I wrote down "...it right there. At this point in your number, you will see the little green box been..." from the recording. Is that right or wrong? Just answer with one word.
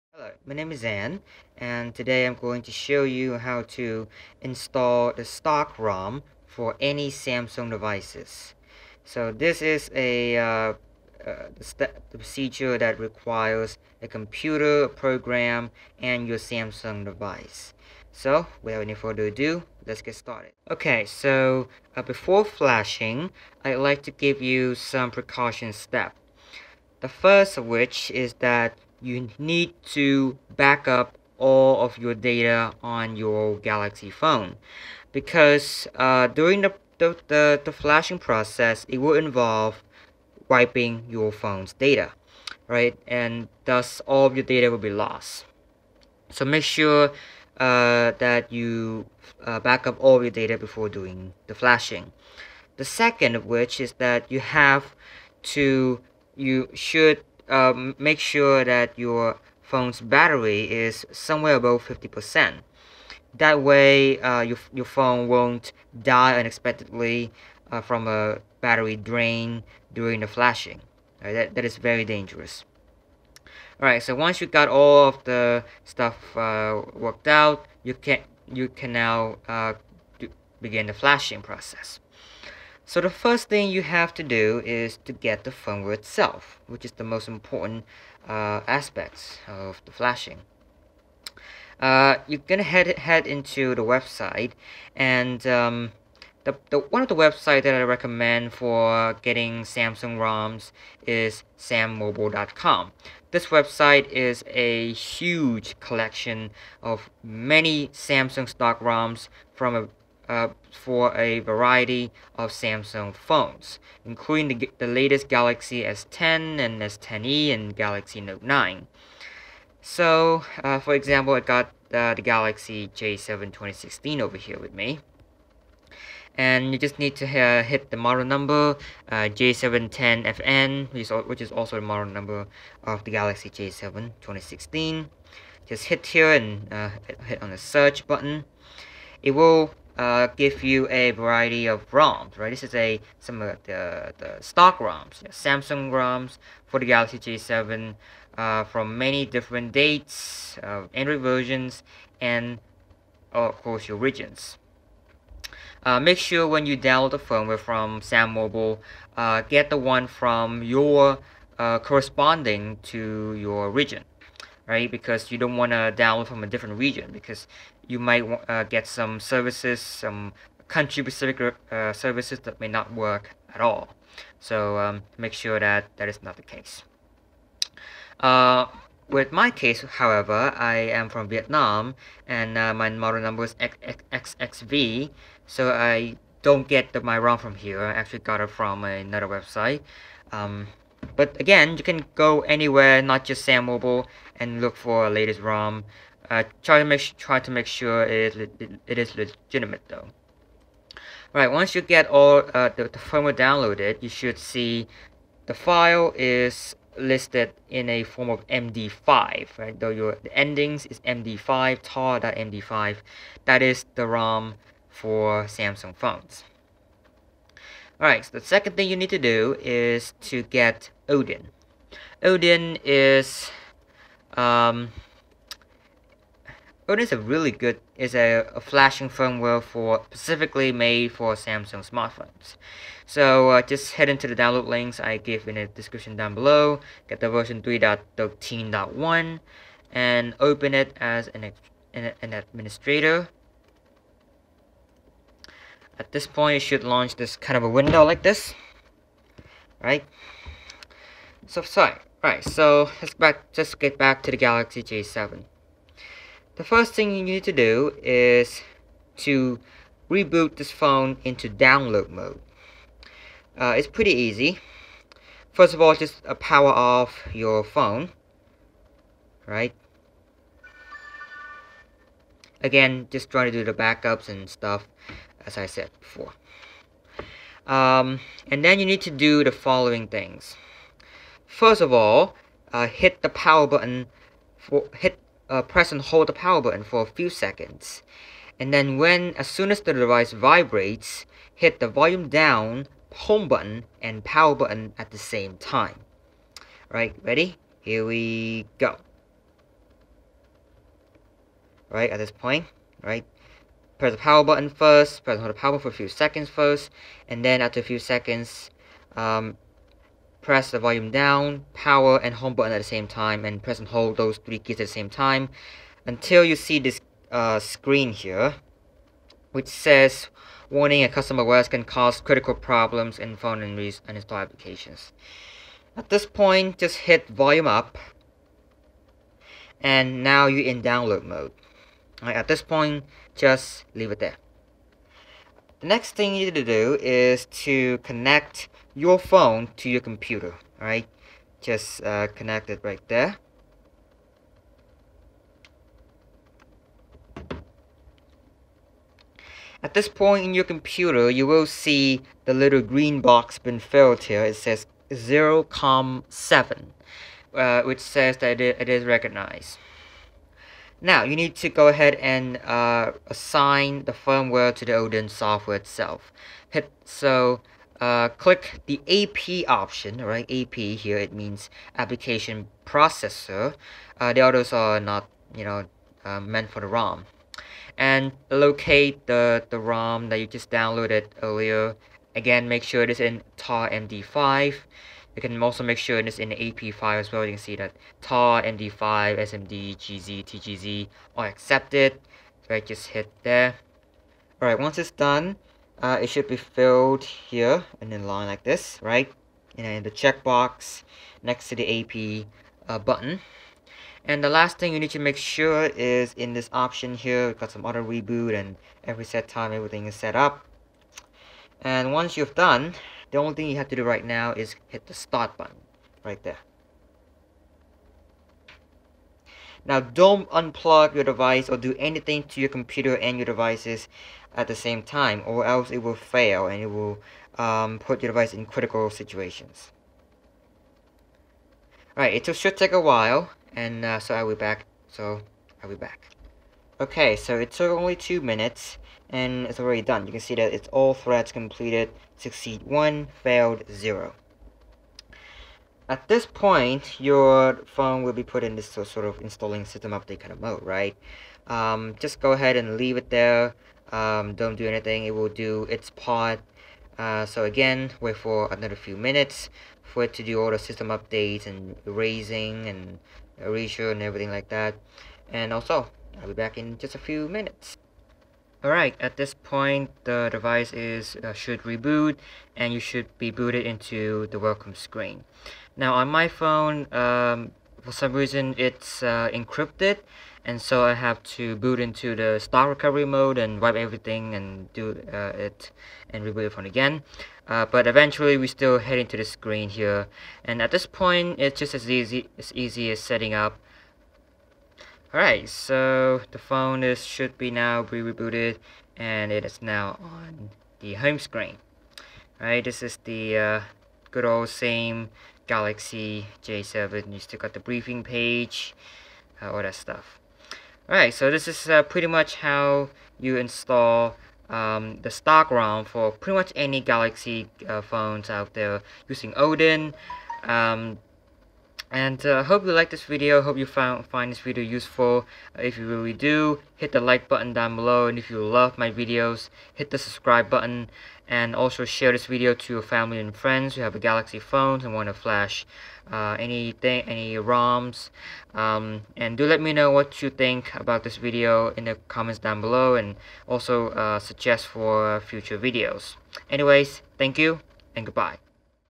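wrong.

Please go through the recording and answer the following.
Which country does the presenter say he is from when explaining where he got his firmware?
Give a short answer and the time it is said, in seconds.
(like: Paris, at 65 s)
Vietnam, at 181 s.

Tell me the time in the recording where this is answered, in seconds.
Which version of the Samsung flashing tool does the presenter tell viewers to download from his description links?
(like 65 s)
237 s.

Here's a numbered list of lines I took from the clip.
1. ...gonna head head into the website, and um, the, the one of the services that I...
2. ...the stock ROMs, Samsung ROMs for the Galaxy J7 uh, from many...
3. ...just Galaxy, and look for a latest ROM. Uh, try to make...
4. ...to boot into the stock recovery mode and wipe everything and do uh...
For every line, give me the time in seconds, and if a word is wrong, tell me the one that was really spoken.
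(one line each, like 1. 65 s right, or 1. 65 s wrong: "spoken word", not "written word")
1. 92 s wrong: "websites", not "services"
2. 144 s right
3. 193 s wrong: "SamMobile", not "Galaxy"
4. 481 s right.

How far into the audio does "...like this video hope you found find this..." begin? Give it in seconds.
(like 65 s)
522 s.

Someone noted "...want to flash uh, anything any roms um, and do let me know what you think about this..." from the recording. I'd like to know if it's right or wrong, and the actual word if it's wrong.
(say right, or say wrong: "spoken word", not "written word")
right.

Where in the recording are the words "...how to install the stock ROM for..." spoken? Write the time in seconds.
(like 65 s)
3 s.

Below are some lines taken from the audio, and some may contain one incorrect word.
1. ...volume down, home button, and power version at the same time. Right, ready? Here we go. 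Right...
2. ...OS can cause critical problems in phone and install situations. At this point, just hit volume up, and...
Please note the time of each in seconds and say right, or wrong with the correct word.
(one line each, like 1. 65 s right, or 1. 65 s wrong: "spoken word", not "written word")
1. 291 s wrong: "button", not "version"
2. 321 s wrong: "applications", not "situations".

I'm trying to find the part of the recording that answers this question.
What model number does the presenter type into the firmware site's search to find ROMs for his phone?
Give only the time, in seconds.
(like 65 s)
129 s.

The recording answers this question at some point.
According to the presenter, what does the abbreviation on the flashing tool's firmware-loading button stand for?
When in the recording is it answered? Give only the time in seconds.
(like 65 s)
371 s.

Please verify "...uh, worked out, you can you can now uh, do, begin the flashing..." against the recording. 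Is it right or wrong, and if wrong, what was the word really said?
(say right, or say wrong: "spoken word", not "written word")
right.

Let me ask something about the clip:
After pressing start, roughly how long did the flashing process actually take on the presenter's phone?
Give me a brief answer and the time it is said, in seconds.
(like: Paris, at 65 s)
two minutes, at 438 s.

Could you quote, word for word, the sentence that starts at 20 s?
Okay, so uh, before flashing, I'd like to give you some precaution steps.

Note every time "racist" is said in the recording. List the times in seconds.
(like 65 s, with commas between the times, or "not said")
not said.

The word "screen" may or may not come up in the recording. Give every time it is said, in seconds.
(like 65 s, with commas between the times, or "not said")
317 s, 474 s, 489 s, 501 s.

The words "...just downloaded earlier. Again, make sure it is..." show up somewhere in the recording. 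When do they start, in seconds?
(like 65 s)
380 s.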